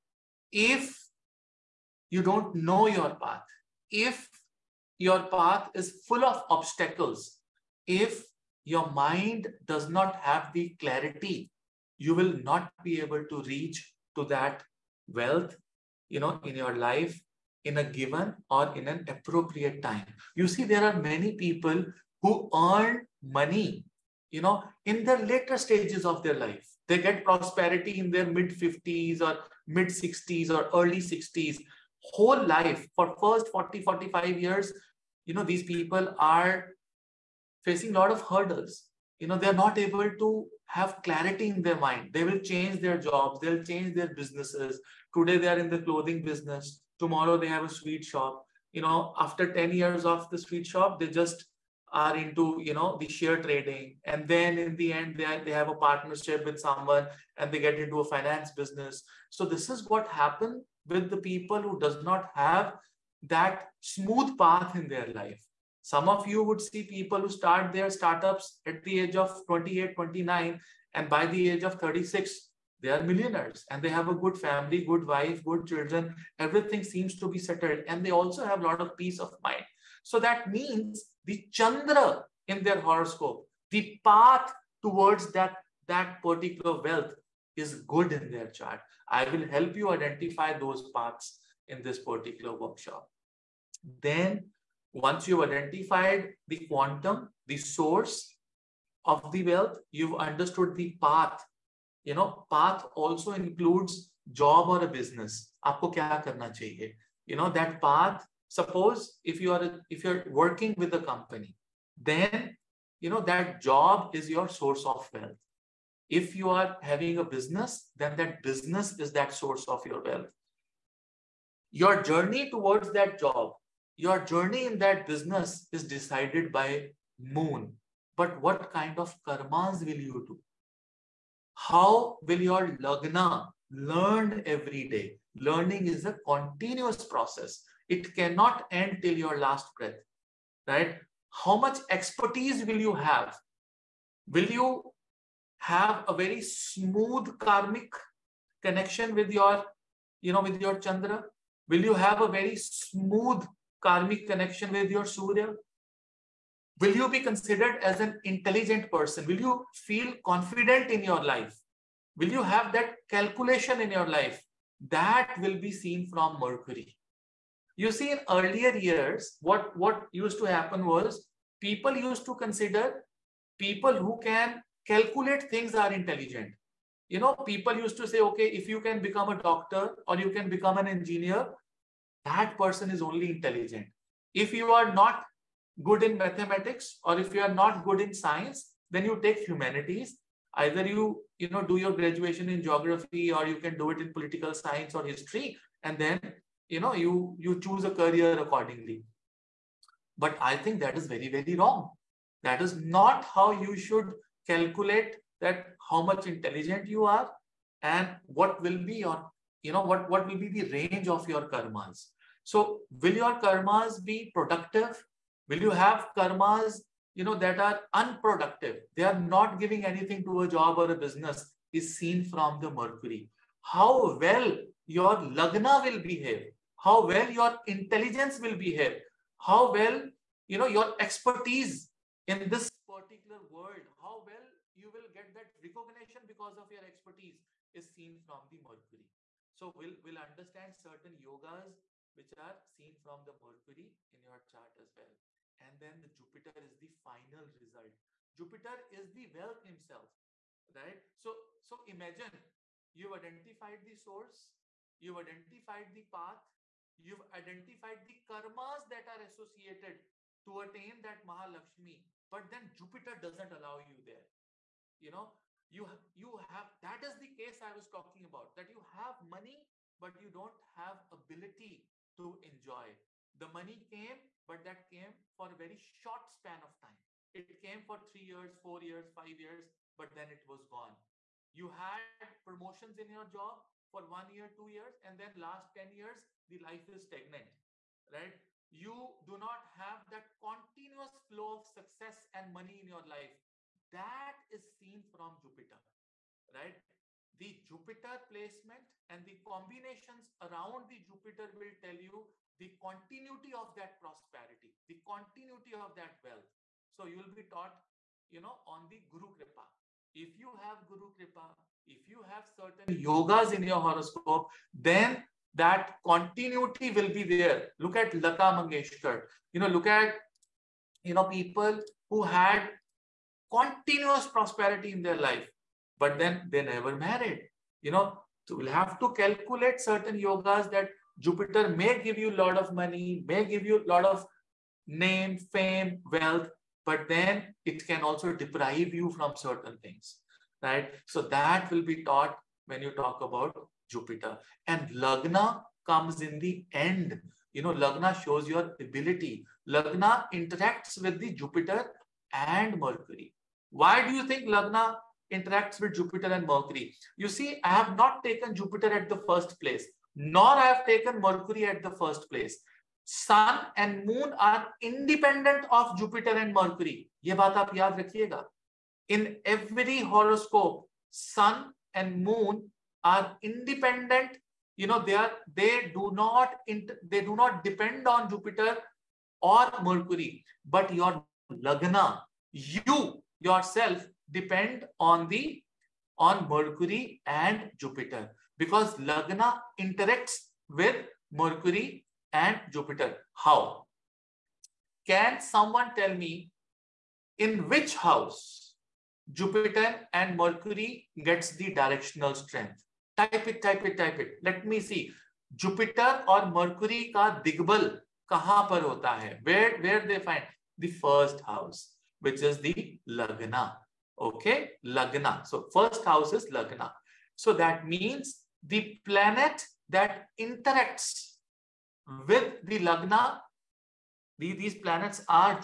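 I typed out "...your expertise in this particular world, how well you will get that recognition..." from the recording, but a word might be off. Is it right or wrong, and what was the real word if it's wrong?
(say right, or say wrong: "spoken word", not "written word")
right.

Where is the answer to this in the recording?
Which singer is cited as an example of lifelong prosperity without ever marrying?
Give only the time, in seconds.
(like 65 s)
318 s.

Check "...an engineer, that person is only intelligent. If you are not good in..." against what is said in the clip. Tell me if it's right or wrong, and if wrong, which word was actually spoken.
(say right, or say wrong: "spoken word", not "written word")
right.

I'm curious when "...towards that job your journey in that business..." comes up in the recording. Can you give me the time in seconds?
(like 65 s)
122 s.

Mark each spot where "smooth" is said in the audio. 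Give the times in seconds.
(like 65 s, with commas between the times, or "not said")
63 s, 146 s, 152 s.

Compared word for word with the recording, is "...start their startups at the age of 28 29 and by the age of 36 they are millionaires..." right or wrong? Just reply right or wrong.
right.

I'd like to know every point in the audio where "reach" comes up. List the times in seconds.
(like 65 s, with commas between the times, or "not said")
13 s.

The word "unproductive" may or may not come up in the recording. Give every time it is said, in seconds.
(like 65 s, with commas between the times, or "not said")
217 s.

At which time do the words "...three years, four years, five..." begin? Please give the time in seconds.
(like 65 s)
278 s.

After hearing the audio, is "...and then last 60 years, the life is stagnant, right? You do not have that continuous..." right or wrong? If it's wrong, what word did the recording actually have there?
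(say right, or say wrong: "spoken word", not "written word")
wrong: "10", not "60".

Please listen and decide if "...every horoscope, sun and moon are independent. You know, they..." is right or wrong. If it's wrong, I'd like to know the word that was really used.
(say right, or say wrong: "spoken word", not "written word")
right.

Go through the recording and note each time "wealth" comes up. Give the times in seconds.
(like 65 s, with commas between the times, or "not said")
15 s, 86 s, 99 s, 115 s, 120 s, 249 s, 306 s, 336 s.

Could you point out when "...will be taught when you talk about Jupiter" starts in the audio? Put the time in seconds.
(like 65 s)
341 s.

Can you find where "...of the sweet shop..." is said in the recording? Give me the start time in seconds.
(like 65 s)
50 s.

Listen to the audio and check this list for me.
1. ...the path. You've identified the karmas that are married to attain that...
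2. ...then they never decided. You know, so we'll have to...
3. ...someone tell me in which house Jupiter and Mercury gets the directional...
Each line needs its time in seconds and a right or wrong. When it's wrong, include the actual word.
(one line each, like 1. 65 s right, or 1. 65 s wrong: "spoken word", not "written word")
1. 255 s wrong: "associated", not "married"
2. 326 s wrong: "married", not "decided"
3. 395 s right.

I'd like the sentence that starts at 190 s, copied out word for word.
Either you, you know, do your graduation in geography or you can do it in political science or history.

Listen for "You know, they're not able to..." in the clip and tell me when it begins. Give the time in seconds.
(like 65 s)
39 s.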